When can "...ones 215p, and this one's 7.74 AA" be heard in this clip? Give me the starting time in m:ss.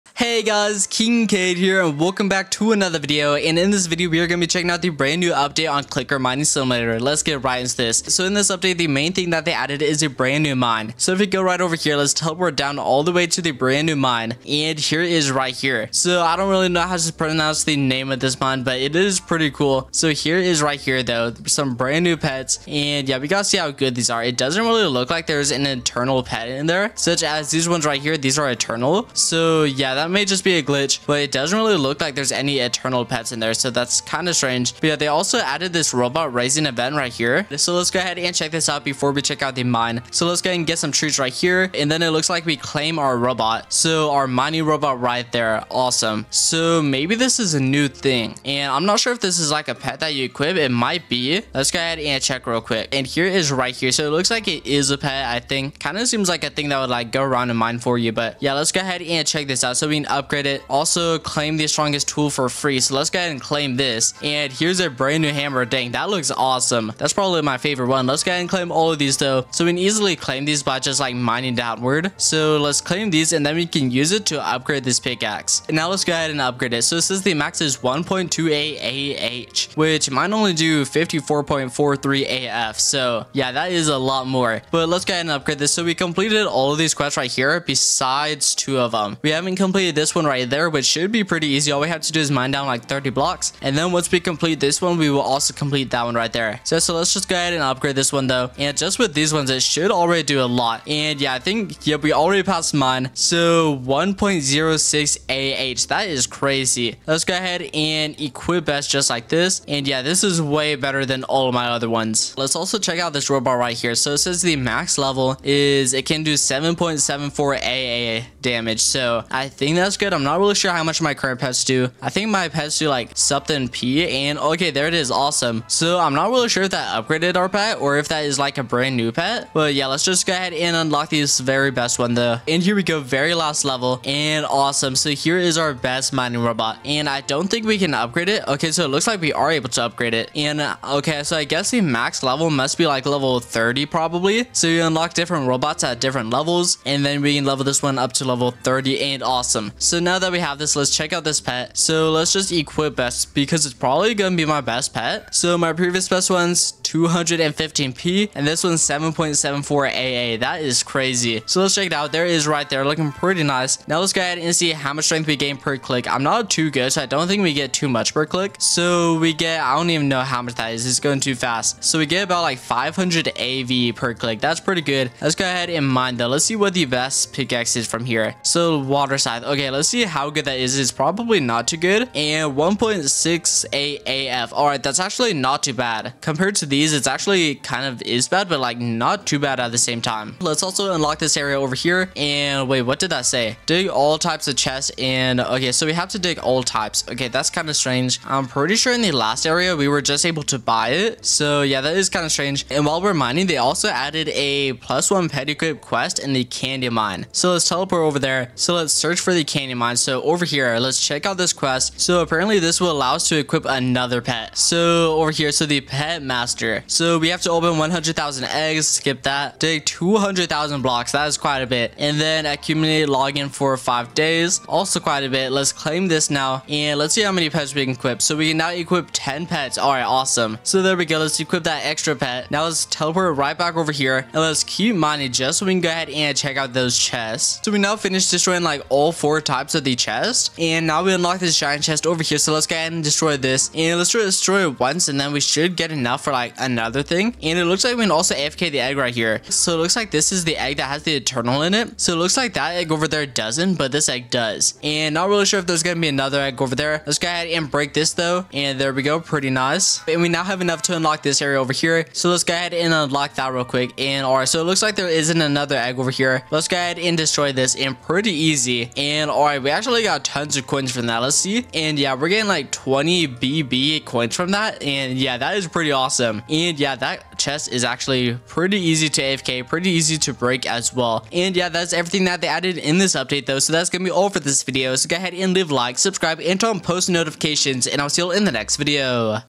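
2:36.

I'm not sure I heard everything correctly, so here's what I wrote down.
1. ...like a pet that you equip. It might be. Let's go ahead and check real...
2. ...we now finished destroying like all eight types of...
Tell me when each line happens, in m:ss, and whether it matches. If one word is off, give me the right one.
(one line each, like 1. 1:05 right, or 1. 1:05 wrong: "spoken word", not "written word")
1. 0:49 right
2. 3:57 wrong: "four", not "eight".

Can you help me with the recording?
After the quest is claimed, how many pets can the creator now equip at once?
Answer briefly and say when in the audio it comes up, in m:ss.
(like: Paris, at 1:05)
10, at 3:49.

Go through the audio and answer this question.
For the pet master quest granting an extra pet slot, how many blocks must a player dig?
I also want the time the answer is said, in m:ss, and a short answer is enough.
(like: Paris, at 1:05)
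200,000, at 3:39.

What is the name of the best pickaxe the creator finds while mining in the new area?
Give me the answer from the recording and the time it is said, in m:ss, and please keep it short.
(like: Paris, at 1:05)
Water scythe, at 2:58.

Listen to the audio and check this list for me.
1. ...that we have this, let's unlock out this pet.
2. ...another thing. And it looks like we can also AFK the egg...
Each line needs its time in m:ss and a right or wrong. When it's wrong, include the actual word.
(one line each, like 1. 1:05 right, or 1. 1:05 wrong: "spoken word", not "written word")
1. 2:30 wrong: "check", not "unlock"
2. 4:06 right.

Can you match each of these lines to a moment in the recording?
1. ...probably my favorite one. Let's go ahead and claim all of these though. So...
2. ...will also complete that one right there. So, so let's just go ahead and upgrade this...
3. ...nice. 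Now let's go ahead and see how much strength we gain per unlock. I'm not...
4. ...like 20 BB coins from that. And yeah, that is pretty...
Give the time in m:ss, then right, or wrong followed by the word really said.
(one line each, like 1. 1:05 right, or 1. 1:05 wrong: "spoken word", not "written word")
1. 1:07 right
2. 1:35 right
3. 2:43 wrong: "click", not "unlock"
4. 4:32 right.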